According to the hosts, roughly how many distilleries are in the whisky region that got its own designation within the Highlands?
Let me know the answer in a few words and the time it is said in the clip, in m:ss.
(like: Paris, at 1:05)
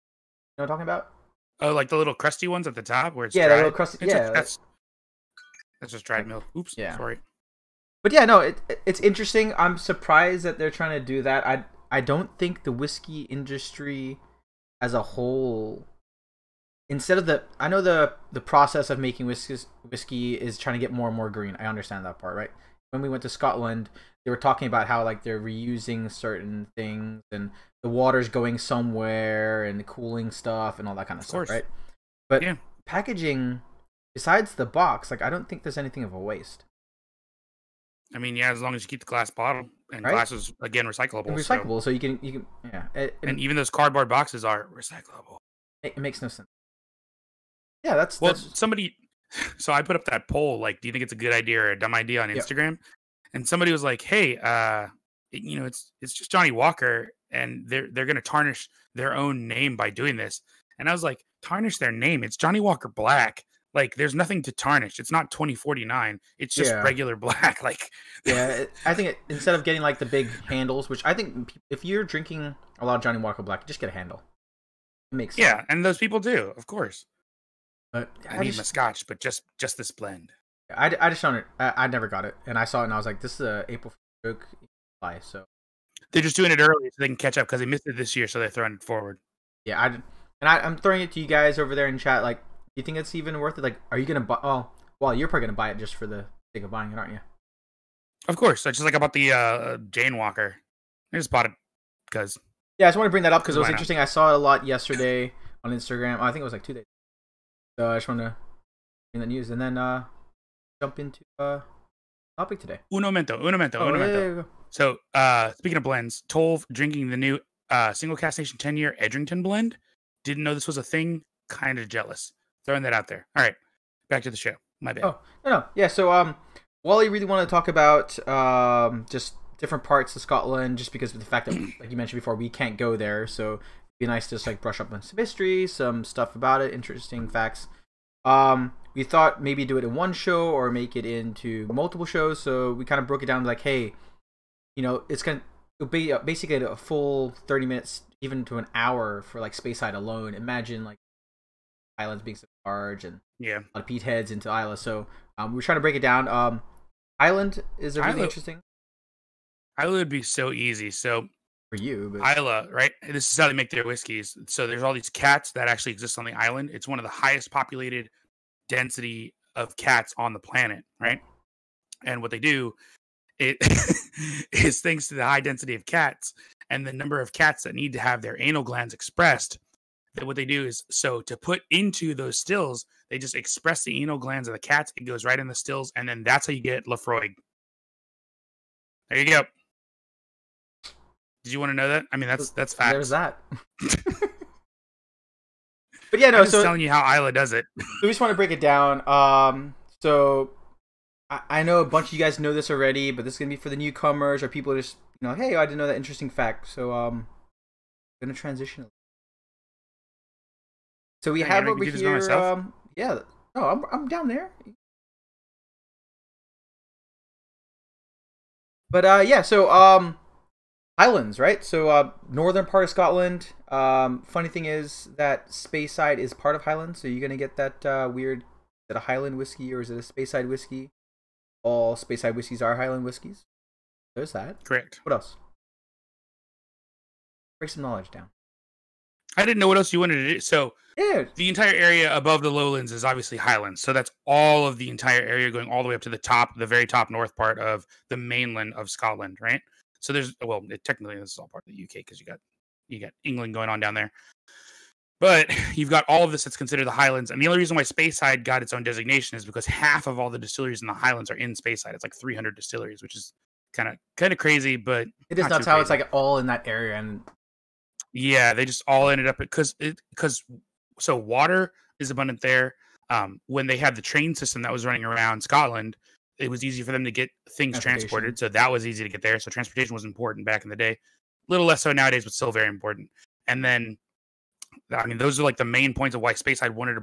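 300, at 4:22.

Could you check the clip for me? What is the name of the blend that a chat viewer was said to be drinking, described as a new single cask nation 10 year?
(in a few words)
Edrington.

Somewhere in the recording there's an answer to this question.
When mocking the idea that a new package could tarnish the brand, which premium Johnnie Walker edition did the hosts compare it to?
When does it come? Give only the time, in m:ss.
1:05.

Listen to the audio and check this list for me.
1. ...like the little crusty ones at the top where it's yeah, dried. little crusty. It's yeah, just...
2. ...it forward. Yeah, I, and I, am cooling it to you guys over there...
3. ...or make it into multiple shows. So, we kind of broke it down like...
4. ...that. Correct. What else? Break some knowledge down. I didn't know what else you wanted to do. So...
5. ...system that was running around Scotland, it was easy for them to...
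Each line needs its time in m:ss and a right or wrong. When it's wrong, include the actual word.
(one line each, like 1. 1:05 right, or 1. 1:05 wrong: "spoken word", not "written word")
1. 0:01 right
2. 1:28 wrong: "throwing", not "cooling"
3. 2:20 right
4. 3:54 right
5. 4:34 right.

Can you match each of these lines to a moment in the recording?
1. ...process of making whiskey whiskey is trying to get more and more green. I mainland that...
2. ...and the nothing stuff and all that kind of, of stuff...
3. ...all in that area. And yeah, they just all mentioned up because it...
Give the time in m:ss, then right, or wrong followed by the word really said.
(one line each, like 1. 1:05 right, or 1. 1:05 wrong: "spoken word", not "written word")
1. 0:18 wrong: "understand", not "mainland"
2. 0:29 wrong: "cooling", not "nothing"
3. 4:26 wrong: "ended", not "mentioned".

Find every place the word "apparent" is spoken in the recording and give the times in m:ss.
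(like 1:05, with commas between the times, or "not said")
not said.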